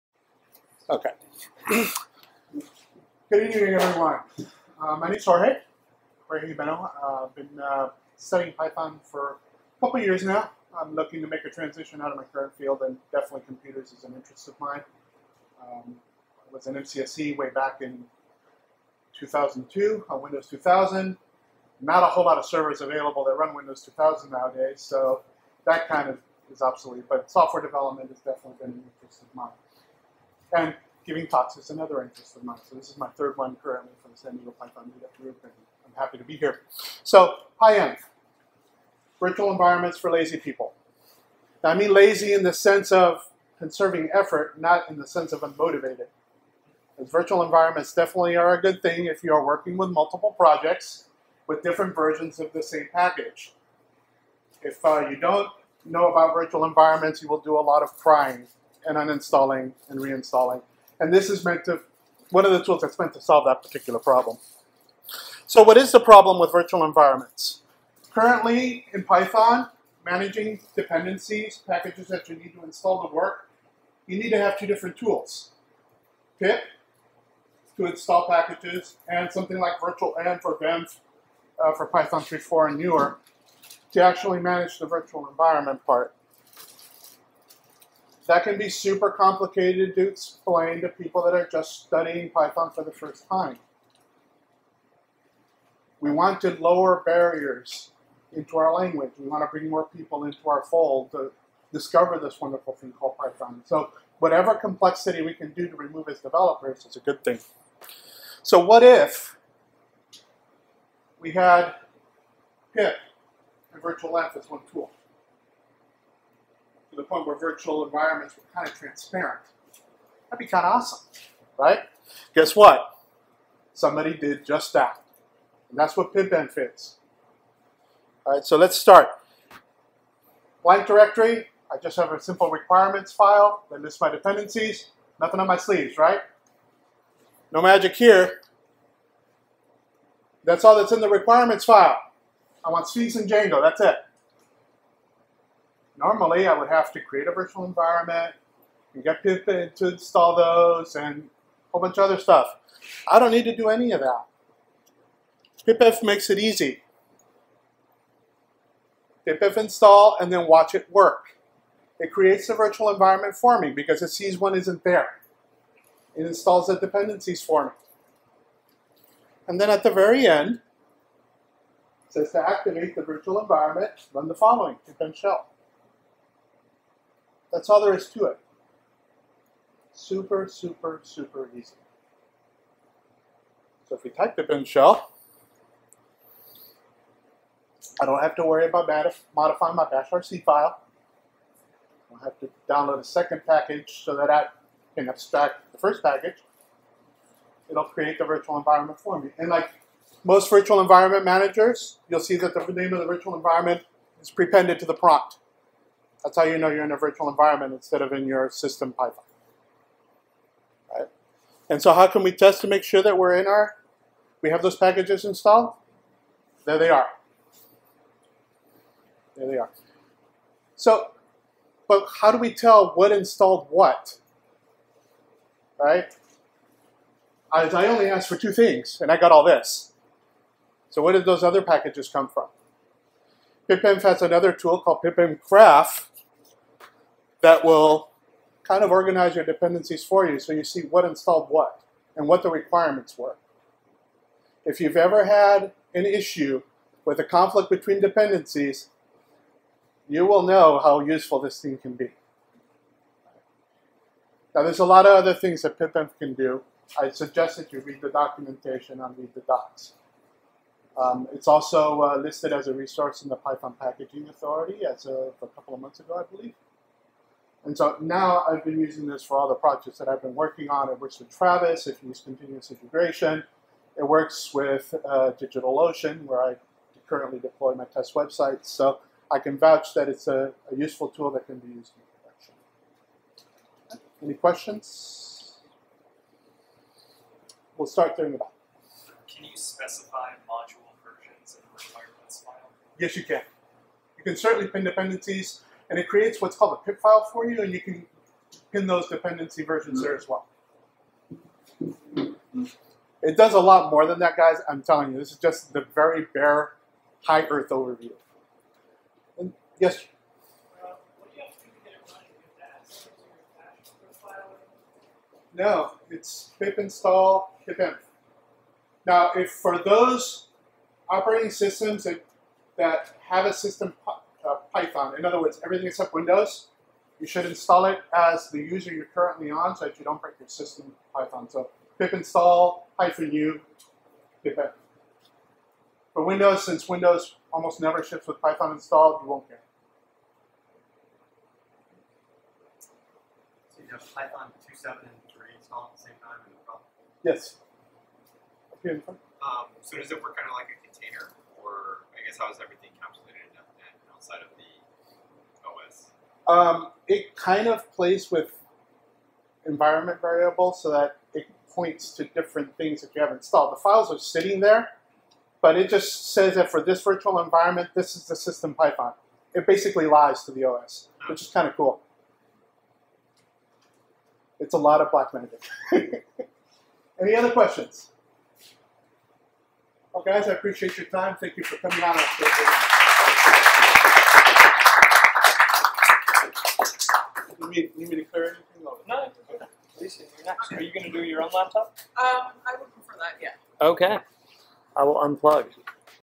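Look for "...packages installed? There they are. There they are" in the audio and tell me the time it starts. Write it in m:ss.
3:34.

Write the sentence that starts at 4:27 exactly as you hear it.
And so now I've been using this for all the projects that I've been working on.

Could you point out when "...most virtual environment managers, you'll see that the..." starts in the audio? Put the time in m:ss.
3:20.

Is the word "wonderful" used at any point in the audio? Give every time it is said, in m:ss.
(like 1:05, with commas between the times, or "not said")
1:42.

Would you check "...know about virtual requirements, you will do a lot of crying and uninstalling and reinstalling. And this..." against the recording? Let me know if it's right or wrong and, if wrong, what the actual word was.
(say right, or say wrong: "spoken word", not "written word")
wrong: "environments", not "requirements".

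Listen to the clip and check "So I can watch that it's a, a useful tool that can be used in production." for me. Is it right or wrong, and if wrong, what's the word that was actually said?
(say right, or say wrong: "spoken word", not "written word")
wrong: "vouch", not "watch".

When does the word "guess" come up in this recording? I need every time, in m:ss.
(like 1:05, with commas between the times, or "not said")
2:02, 5:52.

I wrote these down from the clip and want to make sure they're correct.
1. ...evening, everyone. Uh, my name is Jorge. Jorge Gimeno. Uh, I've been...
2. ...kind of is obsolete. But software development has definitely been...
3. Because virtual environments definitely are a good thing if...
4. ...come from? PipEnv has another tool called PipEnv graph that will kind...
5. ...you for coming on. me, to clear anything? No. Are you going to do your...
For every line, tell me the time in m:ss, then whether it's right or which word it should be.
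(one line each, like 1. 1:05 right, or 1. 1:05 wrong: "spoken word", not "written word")
1. 0:03 right
2. 0:25 right
3. 0:46 right
4. 3:52 right
5. 6:21 right.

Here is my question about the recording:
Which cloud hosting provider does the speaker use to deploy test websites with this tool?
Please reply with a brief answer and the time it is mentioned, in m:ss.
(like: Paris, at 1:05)
DigitalOcean, at 4:35.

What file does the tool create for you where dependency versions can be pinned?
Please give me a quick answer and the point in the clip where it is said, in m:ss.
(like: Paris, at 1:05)
Pipfile, at 4:56.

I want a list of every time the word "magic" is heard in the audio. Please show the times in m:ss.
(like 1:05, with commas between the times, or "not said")
2:17, 6:15.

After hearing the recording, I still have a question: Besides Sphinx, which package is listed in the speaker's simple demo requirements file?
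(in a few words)
Django.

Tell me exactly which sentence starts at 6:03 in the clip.
The files are sitting there, but it just says that for this virtual environment, this is the system Python.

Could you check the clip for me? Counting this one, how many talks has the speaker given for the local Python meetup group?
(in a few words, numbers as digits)
third.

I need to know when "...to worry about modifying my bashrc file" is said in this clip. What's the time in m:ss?
3:08.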